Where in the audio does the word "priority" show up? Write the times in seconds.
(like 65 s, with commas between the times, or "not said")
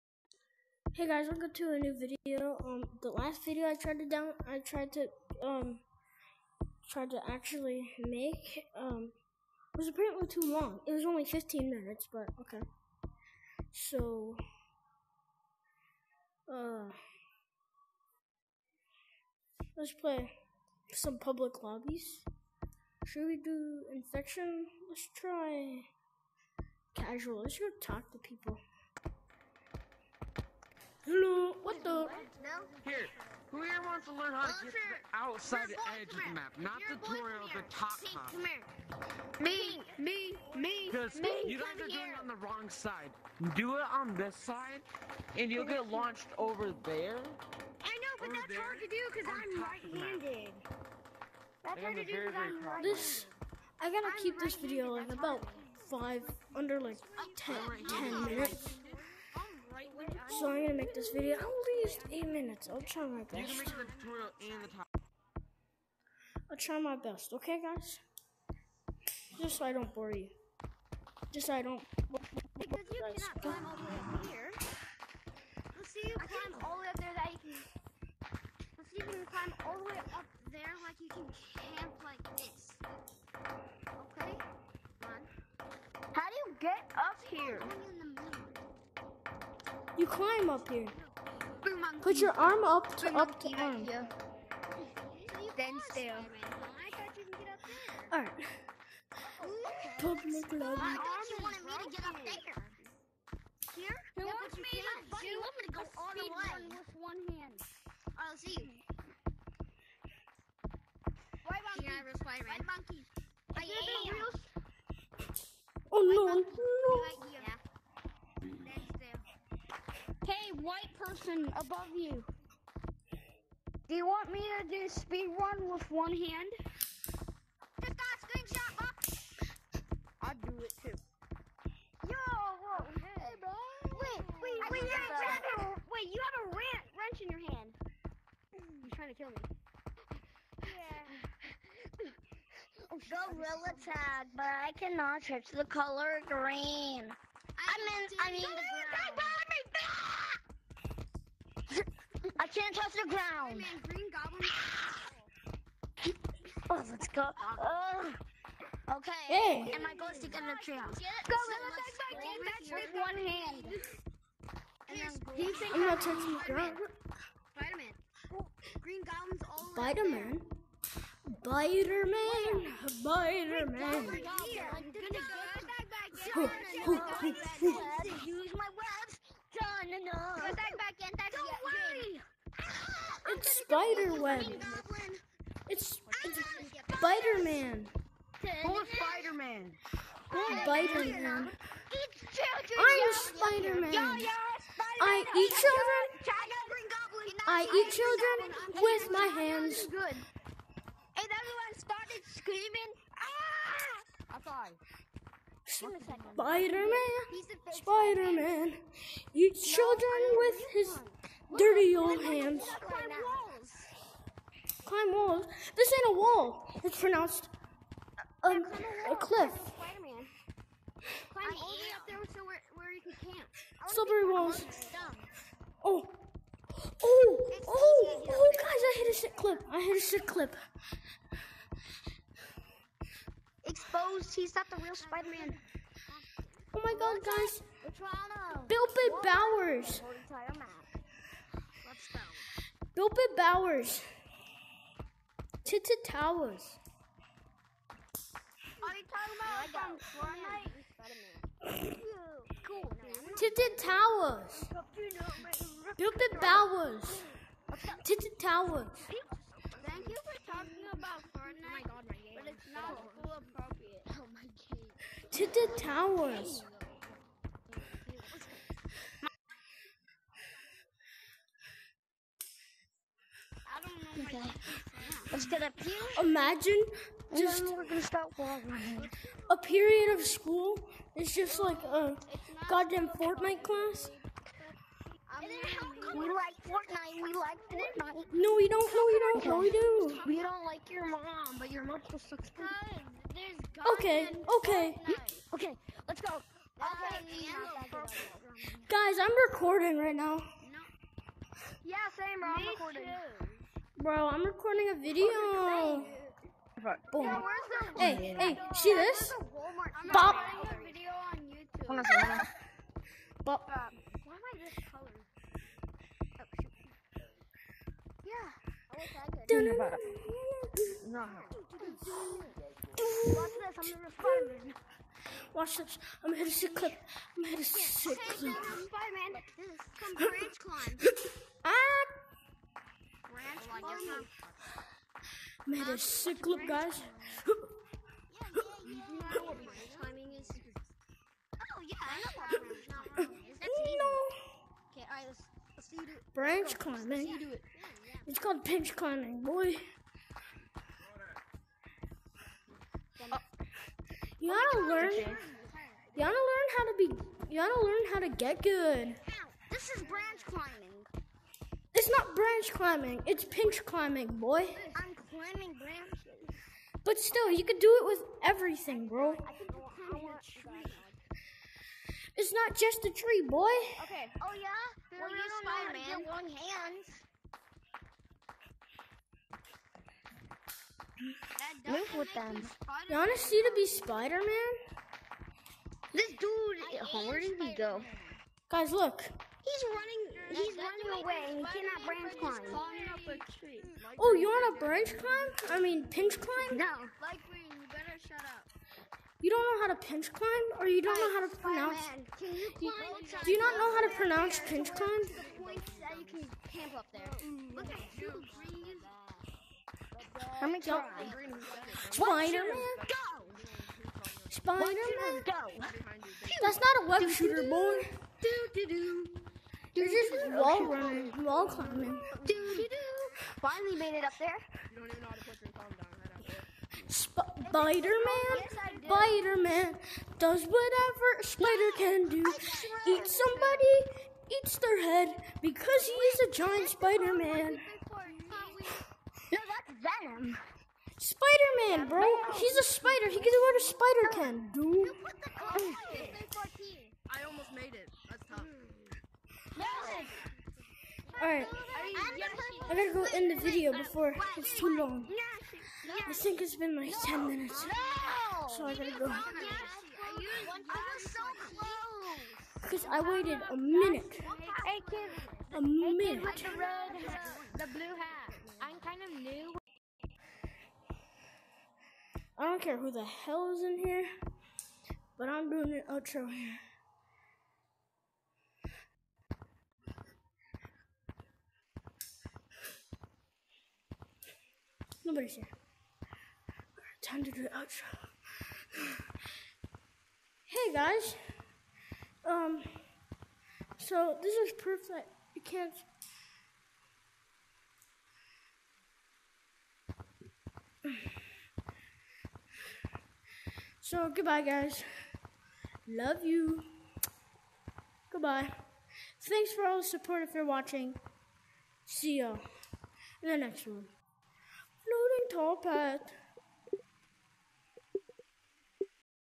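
not said.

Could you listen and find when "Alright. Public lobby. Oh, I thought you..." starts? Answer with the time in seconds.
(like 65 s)
98 s.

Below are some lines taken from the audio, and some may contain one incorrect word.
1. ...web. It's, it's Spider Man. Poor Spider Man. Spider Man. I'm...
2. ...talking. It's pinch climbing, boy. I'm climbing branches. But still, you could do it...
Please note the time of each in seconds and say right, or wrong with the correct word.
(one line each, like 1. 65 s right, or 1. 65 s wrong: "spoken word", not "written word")
1. 184 s right
2. 362 s wrong: "climbing", not "talking".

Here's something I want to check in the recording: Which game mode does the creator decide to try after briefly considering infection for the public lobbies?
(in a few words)
Casual.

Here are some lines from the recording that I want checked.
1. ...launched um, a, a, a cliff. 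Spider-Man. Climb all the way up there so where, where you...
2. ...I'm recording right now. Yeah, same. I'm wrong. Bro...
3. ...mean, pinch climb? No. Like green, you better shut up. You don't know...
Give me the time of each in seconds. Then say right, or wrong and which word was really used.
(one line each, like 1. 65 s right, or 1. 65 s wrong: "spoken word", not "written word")
1. 216 s wrong: "pronounced", not "launched"
2. 299 s wrong: "recording", not "wrong"
3. 395 s right.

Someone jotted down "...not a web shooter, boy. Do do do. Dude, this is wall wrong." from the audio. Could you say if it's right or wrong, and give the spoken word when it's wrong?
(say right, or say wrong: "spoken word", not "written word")
wrong: "running", not "wrong".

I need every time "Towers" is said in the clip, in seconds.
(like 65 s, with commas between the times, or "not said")
246 s, 253 s, 258 s, 265 s.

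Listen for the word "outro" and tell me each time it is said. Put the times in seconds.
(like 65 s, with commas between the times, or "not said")
476 s, 487 s.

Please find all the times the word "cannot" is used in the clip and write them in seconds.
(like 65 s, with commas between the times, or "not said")
72 s, 144 s, 391 s.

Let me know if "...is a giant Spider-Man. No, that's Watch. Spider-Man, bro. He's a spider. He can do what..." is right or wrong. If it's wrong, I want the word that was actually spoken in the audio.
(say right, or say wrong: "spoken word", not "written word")
wrong: "Venom", not "Watch".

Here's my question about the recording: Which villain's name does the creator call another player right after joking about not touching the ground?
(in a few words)
Green Goblin.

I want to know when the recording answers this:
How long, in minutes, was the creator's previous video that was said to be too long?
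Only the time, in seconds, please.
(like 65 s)
11 s.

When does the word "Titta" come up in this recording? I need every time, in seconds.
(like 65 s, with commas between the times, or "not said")
245 s.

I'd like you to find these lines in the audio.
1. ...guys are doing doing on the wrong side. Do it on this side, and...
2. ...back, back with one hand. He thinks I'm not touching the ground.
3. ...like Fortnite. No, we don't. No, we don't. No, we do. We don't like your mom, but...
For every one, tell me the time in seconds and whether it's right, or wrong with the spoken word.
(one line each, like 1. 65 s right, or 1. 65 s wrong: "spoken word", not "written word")
1. 41 s right
2. 162 s right
3. 287 s right.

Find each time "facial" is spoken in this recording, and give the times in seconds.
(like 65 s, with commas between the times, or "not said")
not said.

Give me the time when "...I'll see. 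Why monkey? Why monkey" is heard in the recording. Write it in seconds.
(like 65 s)
108 s.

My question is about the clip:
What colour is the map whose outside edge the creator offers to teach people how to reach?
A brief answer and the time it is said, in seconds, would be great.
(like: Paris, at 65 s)
Pink, at 38 s.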